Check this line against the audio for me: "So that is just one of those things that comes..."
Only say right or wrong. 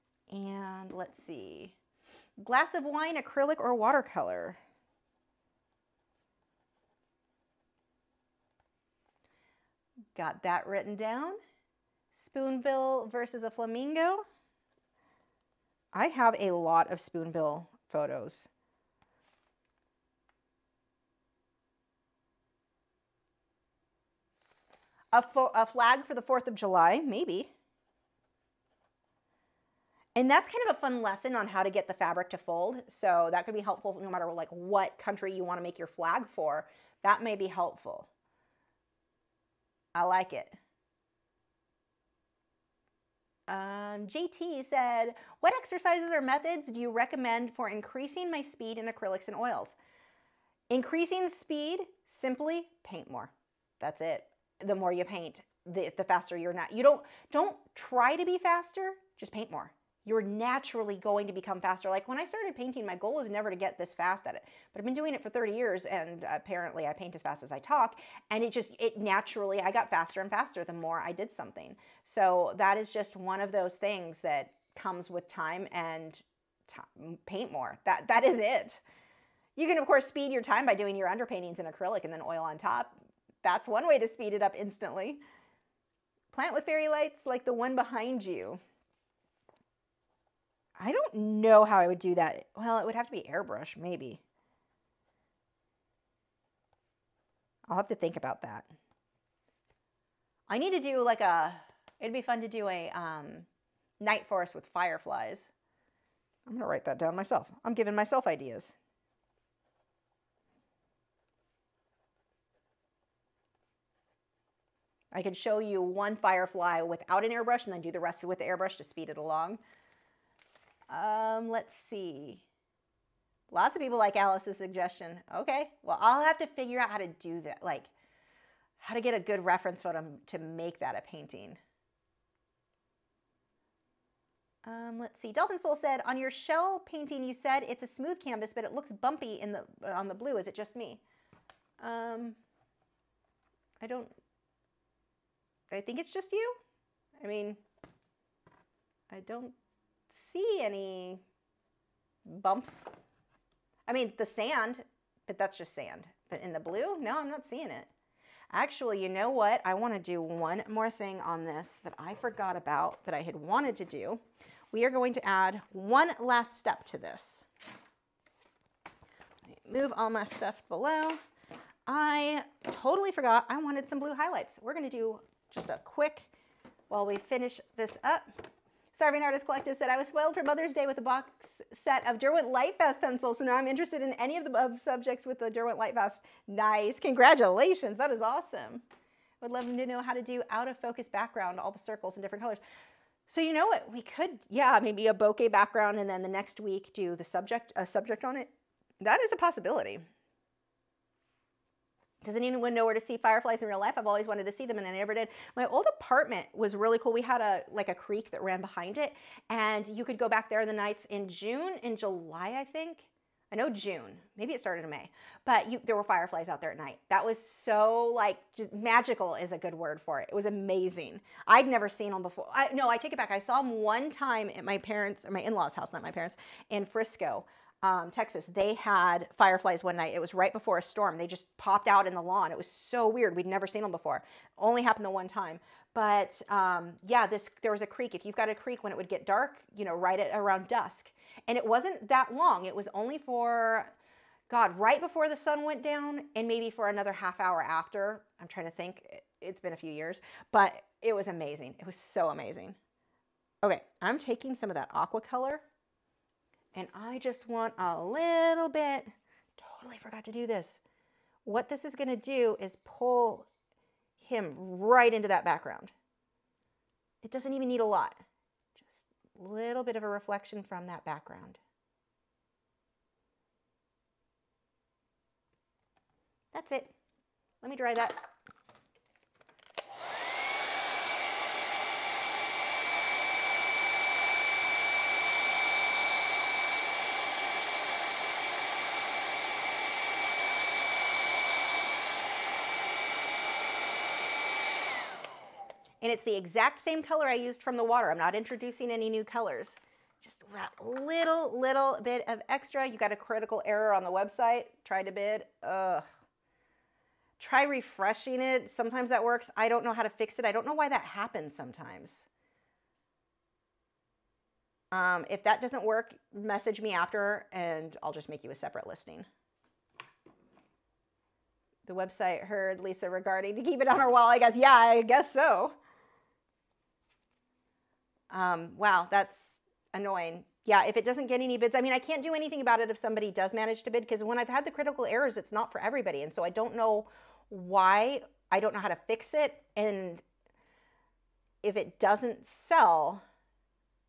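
right.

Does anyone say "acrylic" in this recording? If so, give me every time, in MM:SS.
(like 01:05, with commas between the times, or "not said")
00:03, 00:48, 01:21.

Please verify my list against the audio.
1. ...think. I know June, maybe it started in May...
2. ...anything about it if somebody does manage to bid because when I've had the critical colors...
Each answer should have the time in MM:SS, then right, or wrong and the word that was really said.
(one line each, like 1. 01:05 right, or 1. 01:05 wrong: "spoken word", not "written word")
1. 03:32 right
2. 05:32 wrong: "errors", not "colors".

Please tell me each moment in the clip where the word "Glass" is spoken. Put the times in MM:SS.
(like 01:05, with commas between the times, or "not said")
00:02.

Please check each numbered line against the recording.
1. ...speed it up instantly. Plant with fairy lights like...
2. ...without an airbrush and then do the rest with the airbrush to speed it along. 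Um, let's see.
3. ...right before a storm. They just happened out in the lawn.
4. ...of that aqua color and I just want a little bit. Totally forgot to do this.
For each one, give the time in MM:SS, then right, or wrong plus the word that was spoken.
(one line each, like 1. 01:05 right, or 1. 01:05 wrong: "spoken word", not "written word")
1. 01:24 right
2. 01:56 right
3. 03:50 wrong: "popped", not "happened"
4. 04:14 right.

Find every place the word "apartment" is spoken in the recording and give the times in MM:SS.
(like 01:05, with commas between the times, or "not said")
03:25.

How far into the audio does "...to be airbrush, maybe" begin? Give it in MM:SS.
01:33.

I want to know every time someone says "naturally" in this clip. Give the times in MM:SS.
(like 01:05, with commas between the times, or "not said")
01:00, 01:08.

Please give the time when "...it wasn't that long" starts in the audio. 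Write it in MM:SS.
04:01.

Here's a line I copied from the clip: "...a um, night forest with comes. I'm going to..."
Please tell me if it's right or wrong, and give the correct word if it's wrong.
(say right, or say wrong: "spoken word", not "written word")
wrong: "fireflies", not "comes".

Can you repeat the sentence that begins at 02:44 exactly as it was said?
We are going to add one last step to this.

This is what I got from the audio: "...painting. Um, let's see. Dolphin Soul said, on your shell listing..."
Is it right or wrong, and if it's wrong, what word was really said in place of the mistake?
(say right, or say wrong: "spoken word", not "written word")
wrong: "painting", not "listing".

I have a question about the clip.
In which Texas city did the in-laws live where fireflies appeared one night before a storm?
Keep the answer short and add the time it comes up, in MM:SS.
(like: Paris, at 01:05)
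Frisco, at 03:46.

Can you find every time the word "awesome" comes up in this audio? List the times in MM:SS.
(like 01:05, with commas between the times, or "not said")
03:08.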